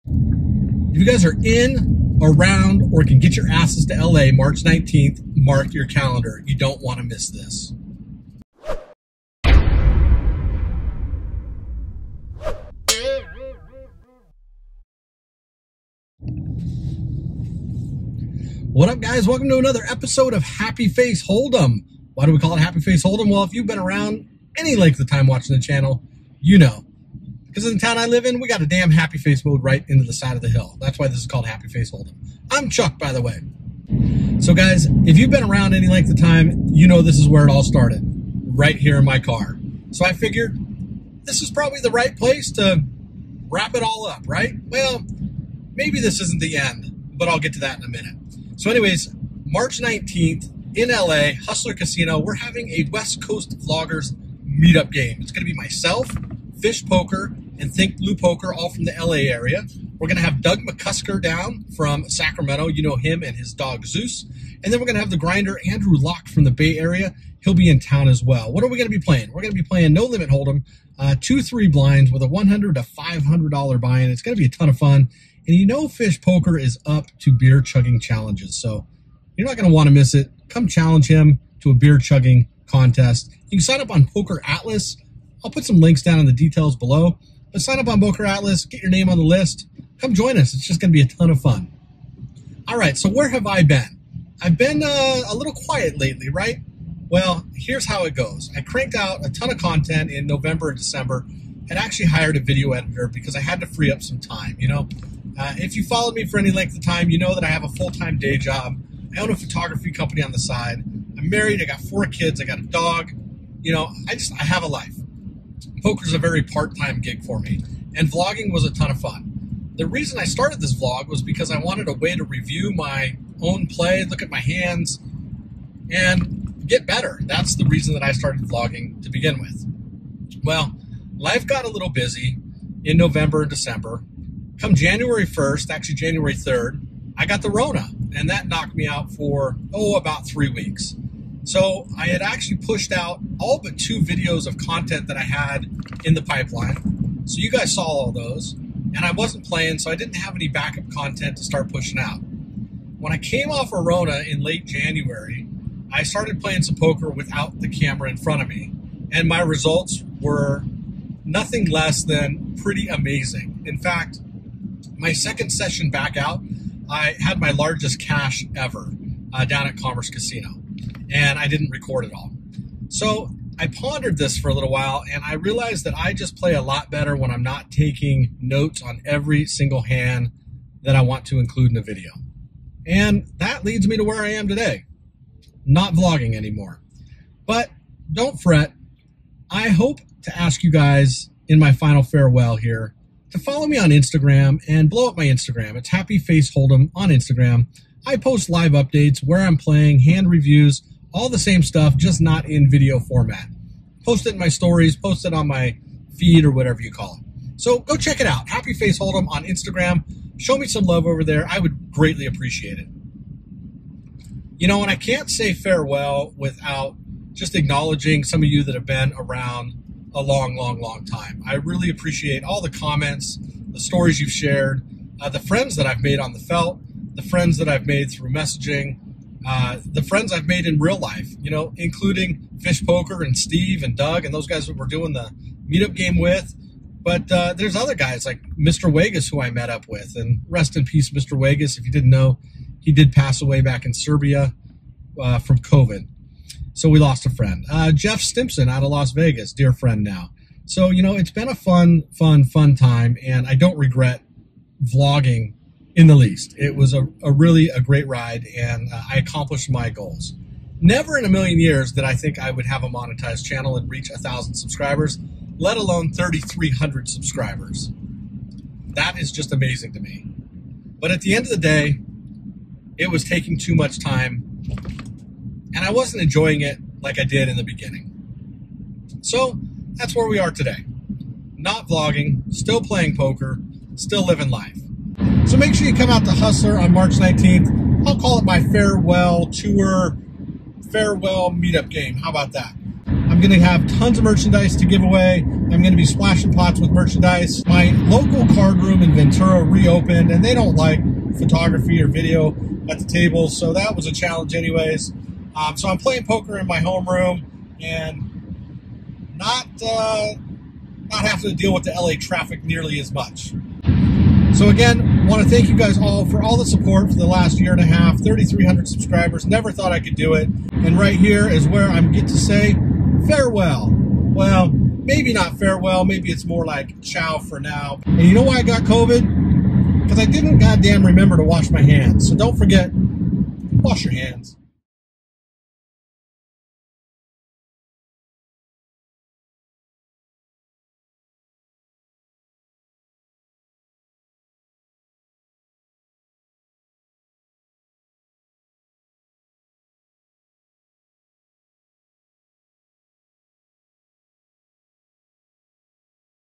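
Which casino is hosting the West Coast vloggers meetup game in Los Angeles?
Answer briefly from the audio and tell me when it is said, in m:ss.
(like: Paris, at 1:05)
Hustler Casino, at 0:51.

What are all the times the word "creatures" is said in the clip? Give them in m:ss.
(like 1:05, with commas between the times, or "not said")
not said.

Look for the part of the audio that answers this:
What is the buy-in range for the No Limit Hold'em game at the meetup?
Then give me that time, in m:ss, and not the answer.
1:12.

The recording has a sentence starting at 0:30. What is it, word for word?
That's why this is called Happy Face Hold'em.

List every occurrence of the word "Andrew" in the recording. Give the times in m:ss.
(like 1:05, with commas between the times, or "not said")
1:05.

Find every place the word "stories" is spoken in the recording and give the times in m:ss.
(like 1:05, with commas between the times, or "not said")
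3:24, 3:43.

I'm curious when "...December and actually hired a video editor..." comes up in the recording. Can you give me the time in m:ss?
1:40.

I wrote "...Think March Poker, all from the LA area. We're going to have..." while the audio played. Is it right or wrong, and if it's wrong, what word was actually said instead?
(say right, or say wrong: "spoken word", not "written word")
wrong: "Blue", not "March".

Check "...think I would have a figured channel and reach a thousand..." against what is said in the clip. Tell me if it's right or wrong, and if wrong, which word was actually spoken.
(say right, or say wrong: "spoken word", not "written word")
wrong: "monetized", not "figured".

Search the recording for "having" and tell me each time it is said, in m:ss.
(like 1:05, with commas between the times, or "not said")
0:52, 5:11.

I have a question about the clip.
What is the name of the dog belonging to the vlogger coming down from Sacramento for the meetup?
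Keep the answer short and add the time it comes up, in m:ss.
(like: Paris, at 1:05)
Zeus, at 1:03.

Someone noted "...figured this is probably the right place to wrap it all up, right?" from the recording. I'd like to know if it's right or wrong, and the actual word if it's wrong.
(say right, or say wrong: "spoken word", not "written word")
right.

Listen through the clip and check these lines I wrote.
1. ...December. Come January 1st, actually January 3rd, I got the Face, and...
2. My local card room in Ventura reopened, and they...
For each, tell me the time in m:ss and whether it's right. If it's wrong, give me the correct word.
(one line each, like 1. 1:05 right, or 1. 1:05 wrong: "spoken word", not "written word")
1. 2:13 wrong: "Rona", not "Face"
2. 4:57 right.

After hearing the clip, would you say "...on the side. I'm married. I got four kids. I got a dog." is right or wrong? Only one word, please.
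right.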